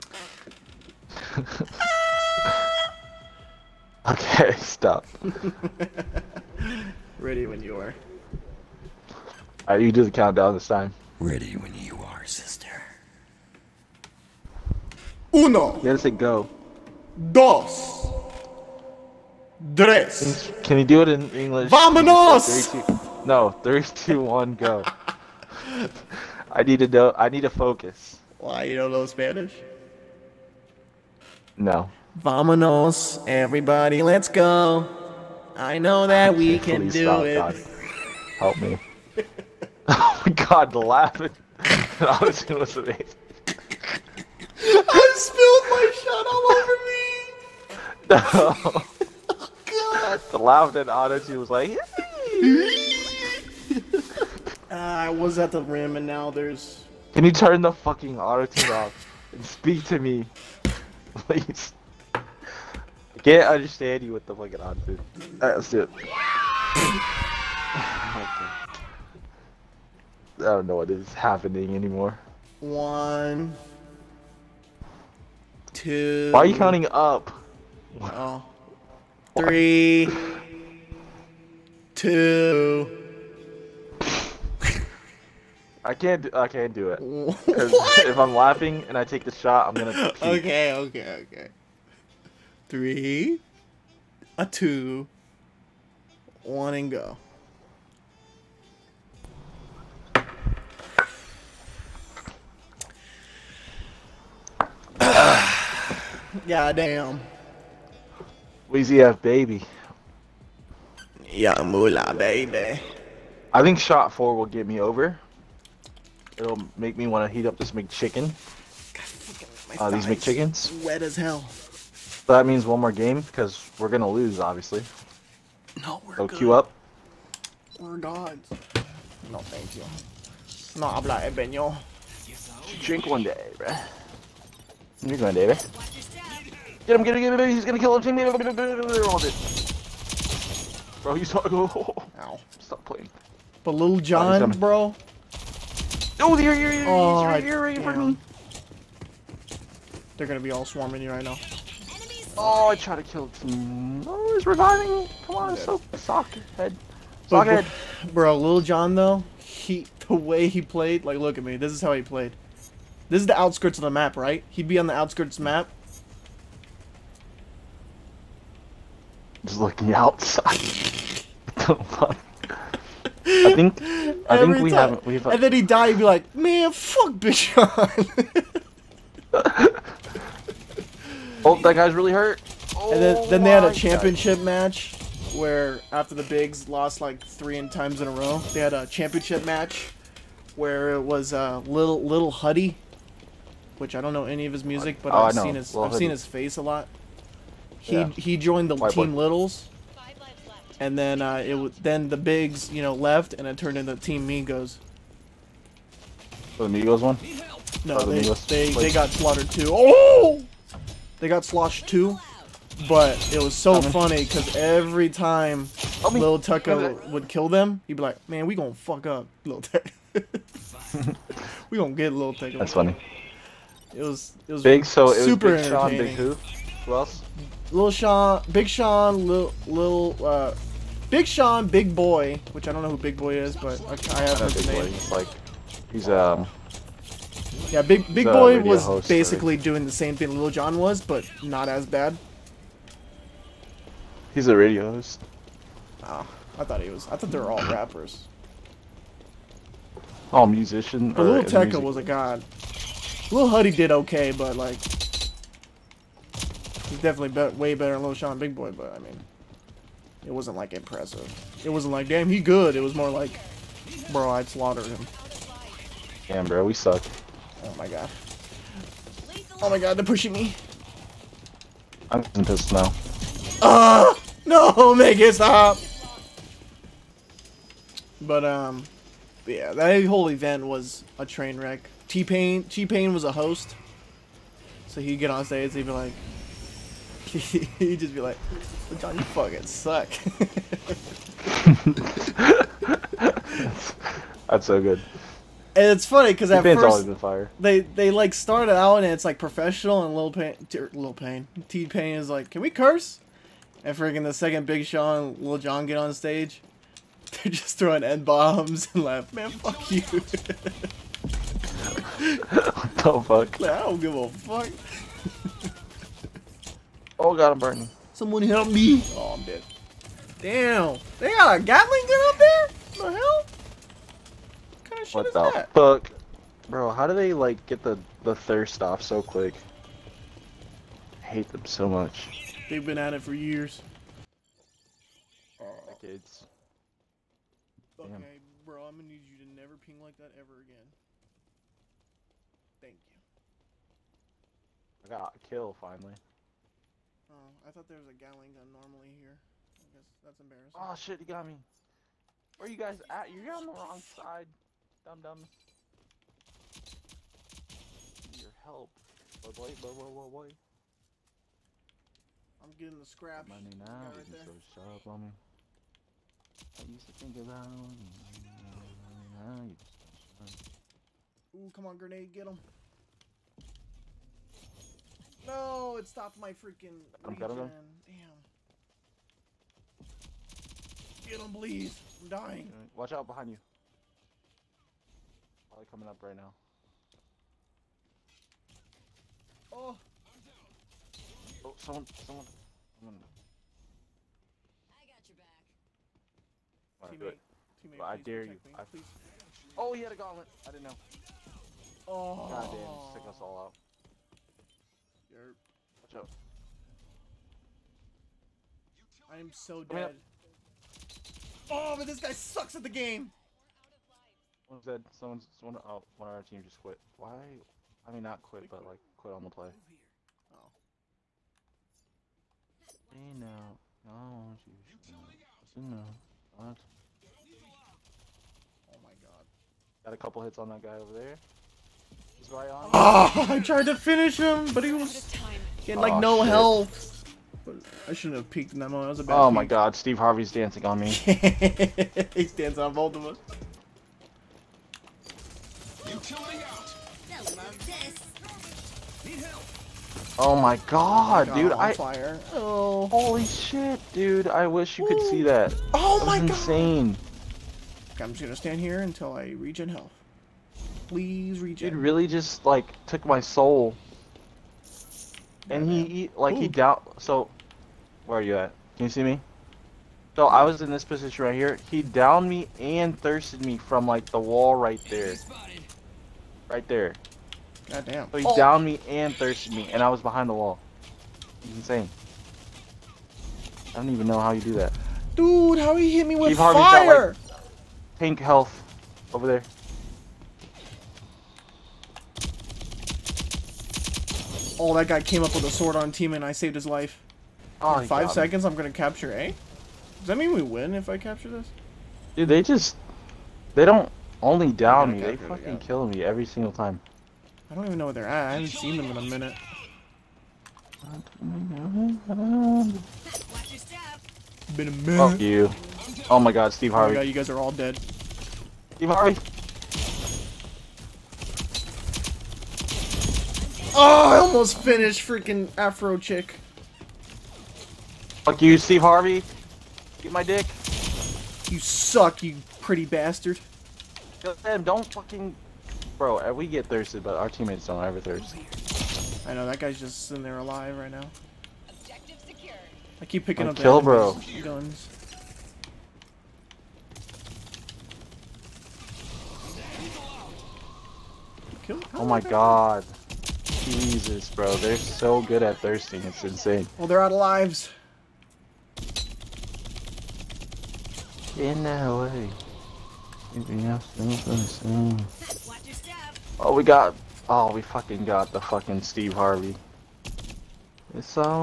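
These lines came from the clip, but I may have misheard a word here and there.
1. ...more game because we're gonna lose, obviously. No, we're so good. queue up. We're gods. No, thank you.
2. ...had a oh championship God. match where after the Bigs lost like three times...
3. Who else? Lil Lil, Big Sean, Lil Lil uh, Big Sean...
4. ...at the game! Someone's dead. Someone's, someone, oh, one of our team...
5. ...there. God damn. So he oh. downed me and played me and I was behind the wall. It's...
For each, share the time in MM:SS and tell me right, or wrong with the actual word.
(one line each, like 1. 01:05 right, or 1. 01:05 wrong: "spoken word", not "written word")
1. 02:02 right
2. 03:03 right
3. 03:46 wrong: "Sean", not "Lil"
4. 06:52 right
5. 07:56 wrong: "thirsted", not "played".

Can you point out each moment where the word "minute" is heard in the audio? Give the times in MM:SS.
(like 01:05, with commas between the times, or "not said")
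08:29, 08:34.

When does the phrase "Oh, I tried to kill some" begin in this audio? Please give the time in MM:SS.
02:32.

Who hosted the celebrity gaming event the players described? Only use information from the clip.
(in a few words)
T-Pain.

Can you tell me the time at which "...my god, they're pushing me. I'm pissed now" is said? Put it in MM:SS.
04:29.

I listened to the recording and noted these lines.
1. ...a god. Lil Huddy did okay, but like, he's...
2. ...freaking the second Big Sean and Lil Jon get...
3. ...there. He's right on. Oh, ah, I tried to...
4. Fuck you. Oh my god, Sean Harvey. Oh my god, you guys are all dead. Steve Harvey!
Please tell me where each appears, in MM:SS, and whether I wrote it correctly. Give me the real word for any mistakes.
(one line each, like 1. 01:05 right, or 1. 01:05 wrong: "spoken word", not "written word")
1. 04:11 right
2. 05:03 right
3. 07:11 right
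4. 08:35 wrong: "Steve", not "Sean".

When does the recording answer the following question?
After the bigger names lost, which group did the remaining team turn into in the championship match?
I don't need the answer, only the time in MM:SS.
03:23.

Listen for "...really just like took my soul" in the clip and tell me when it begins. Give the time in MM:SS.
07:41.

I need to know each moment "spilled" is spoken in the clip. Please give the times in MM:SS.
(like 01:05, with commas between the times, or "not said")
00:45.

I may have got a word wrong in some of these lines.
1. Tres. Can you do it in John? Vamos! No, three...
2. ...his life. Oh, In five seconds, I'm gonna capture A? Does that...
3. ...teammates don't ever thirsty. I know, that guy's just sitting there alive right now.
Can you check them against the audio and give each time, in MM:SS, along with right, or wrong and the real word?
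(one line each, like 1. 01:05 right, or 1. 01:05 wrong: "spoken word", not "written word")
1. 00:19 wrong: "English", not "John"
2. 08:16 right
3. 08:57 right.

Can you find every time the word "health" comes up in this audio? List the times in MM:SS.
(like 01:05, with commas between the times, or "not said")
07:16, 07:39, 08:08.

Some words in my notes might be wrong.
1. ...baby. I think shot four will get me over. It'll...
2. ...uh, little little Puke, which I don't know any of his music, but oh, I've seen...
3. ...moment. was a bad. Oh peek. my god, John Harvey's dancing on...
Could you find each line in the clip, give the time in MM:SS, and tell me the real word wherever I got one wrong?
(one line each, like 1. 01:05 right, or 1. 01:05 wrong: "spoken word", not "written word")
1. 01:52 right
2. 03:11 wrong: "Huddy", not "Puke"
3. 07:18 wrong: "Steve", not "John".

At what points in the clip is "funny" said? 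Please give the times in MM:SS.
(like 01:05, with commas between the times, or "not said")
03:33, 03:42, 04:56.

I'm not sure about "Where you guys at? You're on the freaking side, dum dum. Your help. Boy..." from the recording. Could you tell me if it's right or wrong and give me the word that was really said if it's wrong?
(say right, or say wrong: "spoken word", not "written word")
wrong: "wrong", not "freaking".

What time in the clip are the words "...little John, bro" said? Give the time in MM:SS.
02:23.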